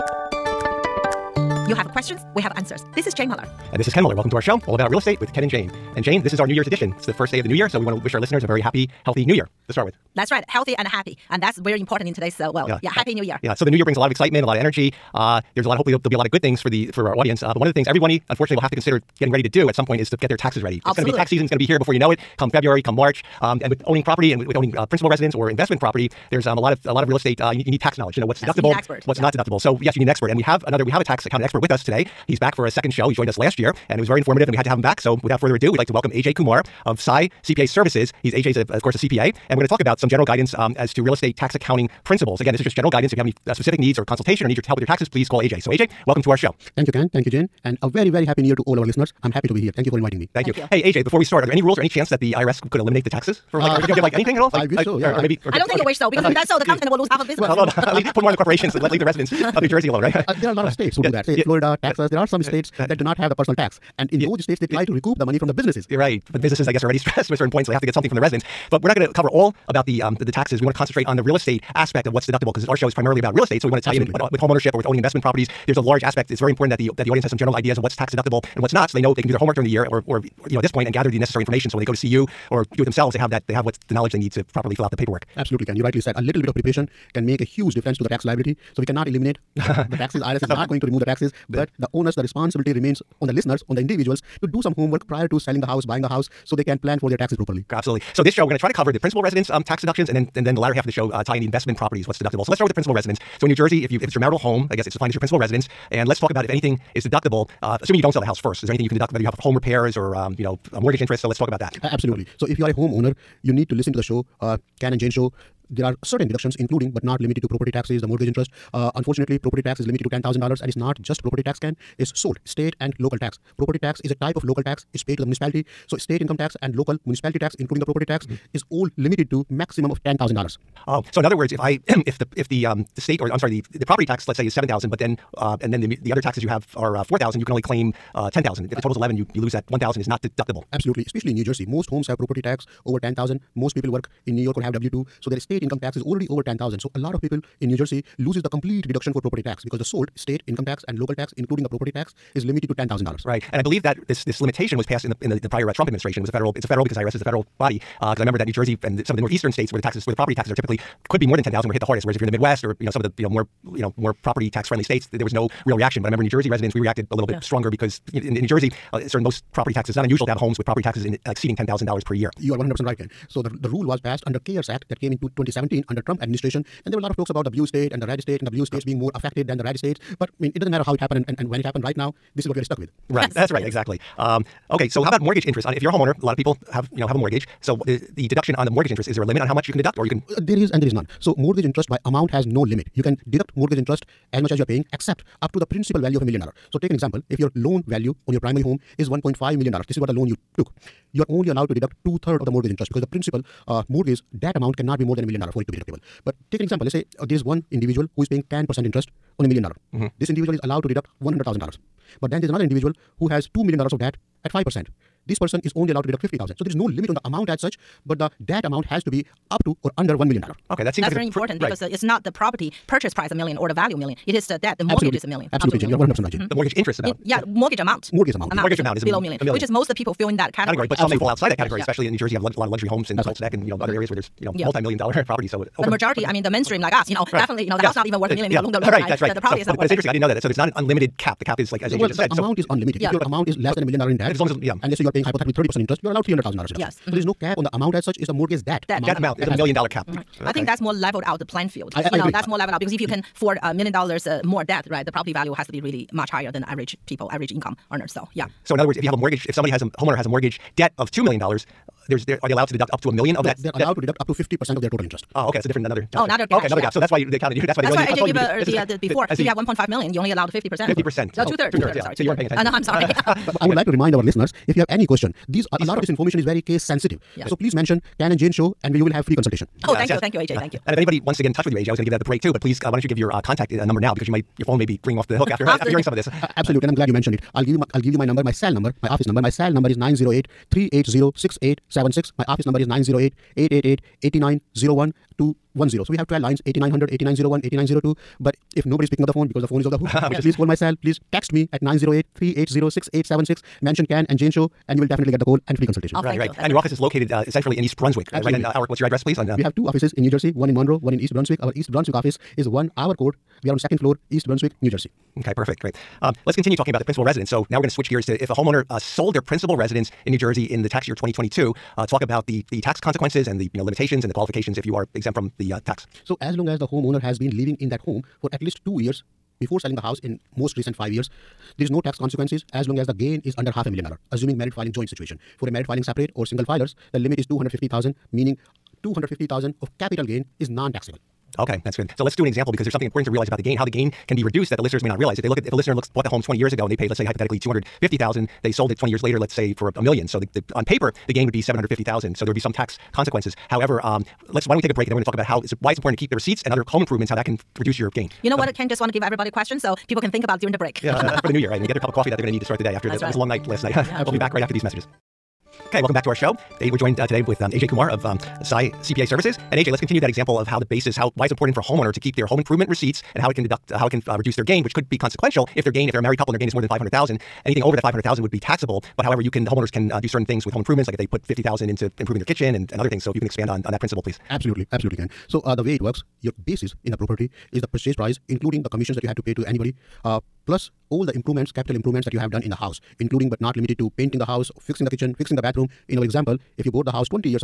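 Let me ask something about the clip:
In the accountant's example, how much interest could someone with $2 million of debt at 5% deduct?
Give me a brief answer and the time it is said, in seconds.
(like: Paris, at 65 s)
$50,000, at 216 s.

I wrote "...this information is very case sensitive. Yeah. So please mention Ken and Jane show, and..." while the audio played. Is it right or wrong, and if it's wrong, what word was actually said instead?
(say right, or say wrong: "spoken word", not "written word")
right.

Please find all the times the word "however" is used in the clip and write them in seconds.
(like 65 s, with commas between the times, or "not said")
353 s, 379 s.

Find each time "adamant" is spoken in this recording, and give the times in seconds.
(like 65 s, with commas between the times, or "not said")
not said.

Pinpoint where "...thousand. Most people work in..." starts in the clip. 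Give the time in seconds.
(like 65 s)
143 s.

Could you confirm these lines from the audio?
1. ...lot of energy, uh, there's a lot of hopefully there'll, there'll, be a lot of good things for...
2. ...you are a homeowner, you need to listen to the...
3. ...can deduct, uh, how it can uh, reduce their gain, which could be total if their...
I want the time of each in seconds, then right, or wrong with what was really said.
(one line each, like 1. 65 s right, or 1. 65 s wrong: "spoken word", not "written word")
1. 14 s right
2. 112 s right
3. 373 s wrong: "consequential", not "total".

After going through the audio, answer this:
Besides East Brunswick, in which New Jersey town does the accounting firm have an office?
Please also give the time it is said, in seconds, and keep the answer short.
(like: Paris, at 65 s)
Monroe, at 310 s.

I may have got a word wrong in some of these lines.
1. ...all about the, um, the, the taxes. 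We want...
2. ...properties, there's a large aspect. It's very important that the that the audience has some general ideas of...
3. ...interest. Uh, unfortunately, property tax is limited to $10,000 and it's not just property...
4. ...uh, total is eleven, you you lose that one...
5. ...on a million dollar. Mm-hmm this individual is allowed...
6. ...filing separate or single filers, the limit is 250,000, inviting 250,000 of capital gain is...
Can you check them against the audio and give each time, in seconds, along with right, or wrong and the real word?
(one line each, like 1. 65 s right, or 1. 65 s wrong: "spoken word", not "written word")
1. 69 s right
2. 75 s right
3. 118 s right
4. 138 s right
5. 209 s right
6. 335 s wrong: "meaning", not "inviting".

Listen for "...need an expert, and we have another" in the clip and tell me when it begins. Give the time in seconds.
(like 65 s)
29 s.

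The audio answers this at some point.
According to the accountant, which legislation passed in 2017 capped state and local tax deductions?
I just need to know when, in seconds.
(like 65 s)
174 s.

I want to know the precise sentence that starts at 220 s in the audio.
Okay, that seems That's like it's very important because right.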